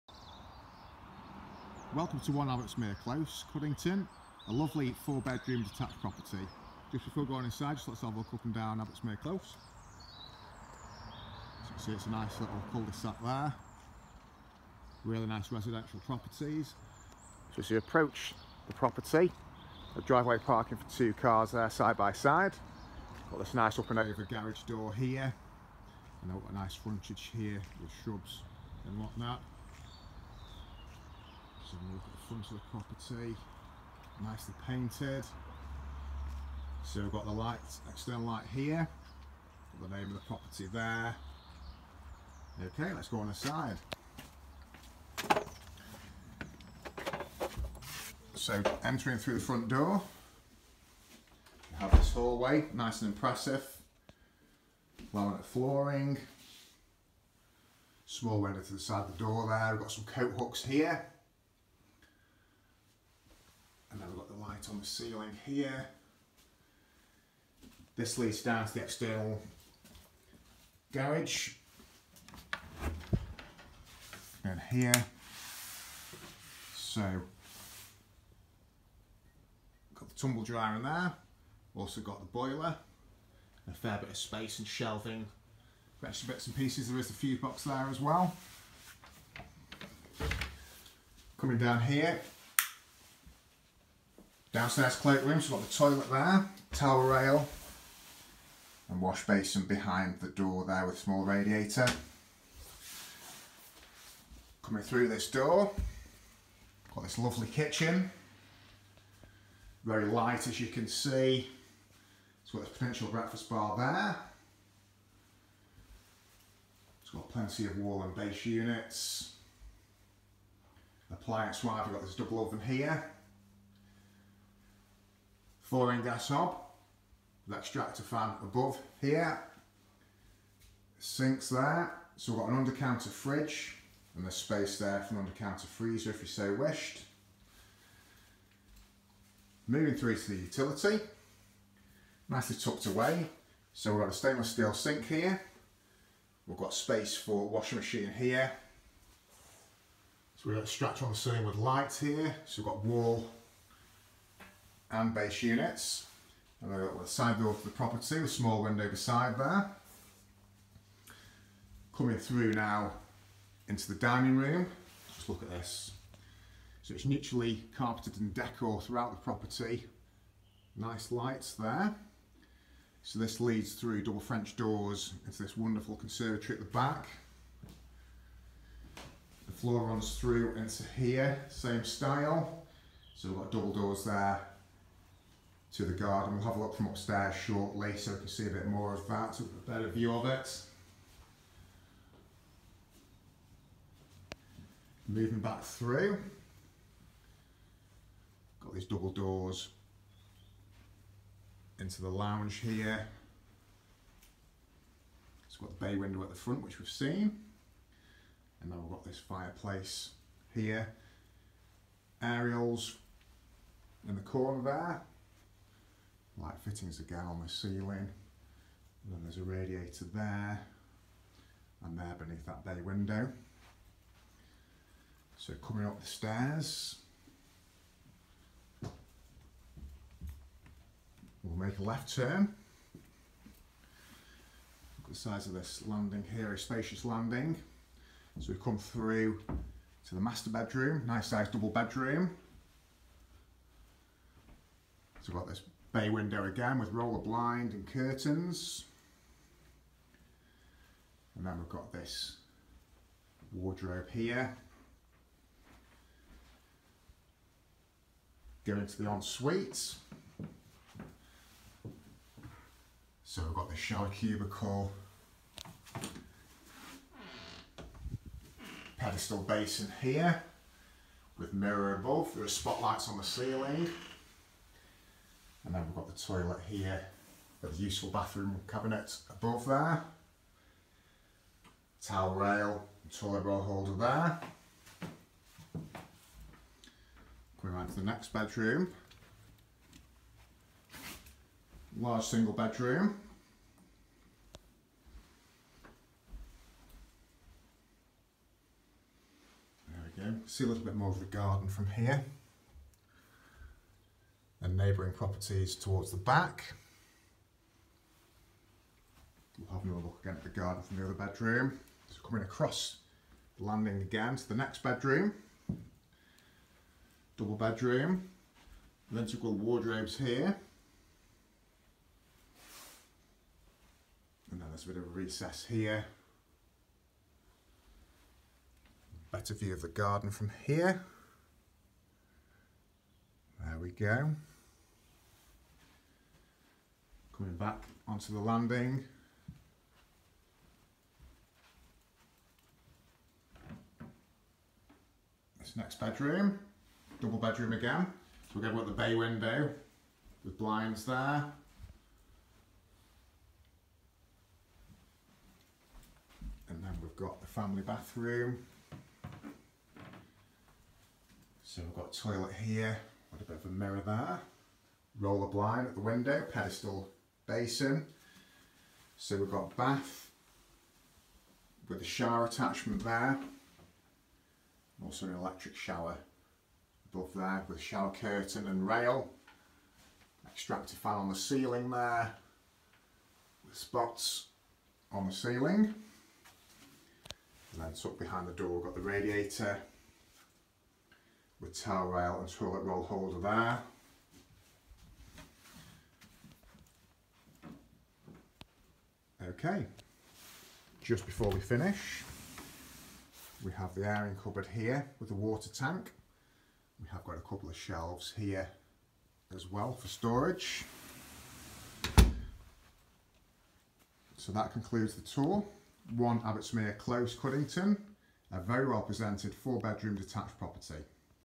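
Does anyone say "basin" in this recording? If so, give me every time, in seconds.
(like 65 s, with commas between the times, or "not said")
99 s, 269 s, 367 s.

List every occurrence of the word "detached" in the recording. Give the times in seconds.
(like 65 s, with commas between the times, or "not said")
5 s, 420 s.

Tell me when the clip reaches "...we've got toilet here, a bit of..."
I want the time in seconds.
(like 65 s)
361 s.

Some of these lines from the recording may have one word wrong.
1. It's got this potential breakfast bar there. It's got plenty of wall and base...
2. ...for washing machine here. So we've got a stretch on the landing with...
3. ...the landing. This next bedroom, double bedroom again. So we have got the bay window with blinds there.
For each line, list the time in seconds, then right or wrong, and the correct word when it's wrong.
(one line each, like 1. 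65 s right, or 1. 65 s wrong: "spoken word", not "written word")
1. 112 s right
2. 147 s wrong: "ceiling", not "landing"
3. 338 s right.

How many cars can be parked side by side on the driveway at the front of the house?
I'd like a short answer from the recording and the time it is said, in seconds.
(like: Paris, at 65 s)
2, at 20 s.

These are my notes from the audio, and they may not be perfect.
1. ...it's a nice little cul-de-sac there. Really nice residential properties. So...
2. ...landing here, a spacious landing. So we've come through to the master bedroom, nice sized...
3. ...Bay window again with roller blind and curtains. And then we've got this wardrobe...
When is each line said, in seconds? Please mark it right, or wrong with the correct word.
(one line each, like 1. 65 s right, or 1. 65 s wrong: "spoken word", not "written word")
1. 11 s right
2. 235 s right
3. 245 s right.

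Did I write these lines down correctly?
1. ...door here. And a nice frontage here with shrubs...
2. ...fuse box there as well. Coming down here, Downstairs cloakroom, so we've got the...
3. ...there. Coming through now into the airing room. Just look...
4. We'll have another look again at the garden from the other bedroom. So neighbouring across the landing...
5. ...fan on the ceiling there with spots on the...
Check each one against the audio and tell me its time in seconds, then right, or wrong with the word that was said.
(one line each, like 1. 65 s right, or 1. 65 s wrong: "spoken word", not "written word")
1. 24 s right
2. 87 s right
3. 159 s wrong: "dining", not "airing"
4. 309 s wrong: "coming", not "neighbouring"
5. 380 s right.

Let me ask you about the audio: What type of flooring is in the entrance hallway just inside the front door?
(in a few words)
Laminate.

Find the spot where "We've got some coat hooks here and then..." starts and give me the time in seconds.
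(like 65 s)
59 s.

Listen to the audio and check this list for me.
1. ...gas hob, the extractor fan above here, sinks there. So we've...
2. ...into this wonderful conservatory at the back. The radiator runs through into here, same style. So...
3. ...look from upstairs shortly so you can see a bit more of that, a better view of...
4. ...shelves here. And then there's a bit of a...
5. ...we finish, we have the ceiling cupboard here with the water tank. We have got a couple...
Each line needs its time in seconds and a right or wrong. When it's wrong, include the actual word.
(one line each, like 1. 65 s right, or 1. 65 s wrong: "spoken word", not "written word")
1. 126 s right
2. 175 s wrong: "floor", not "radiator"
3. 186 s right
4. 319 s wrong: "wardrobes", not "shelves"
5. 401 s wrong: "airing", not "ceiling".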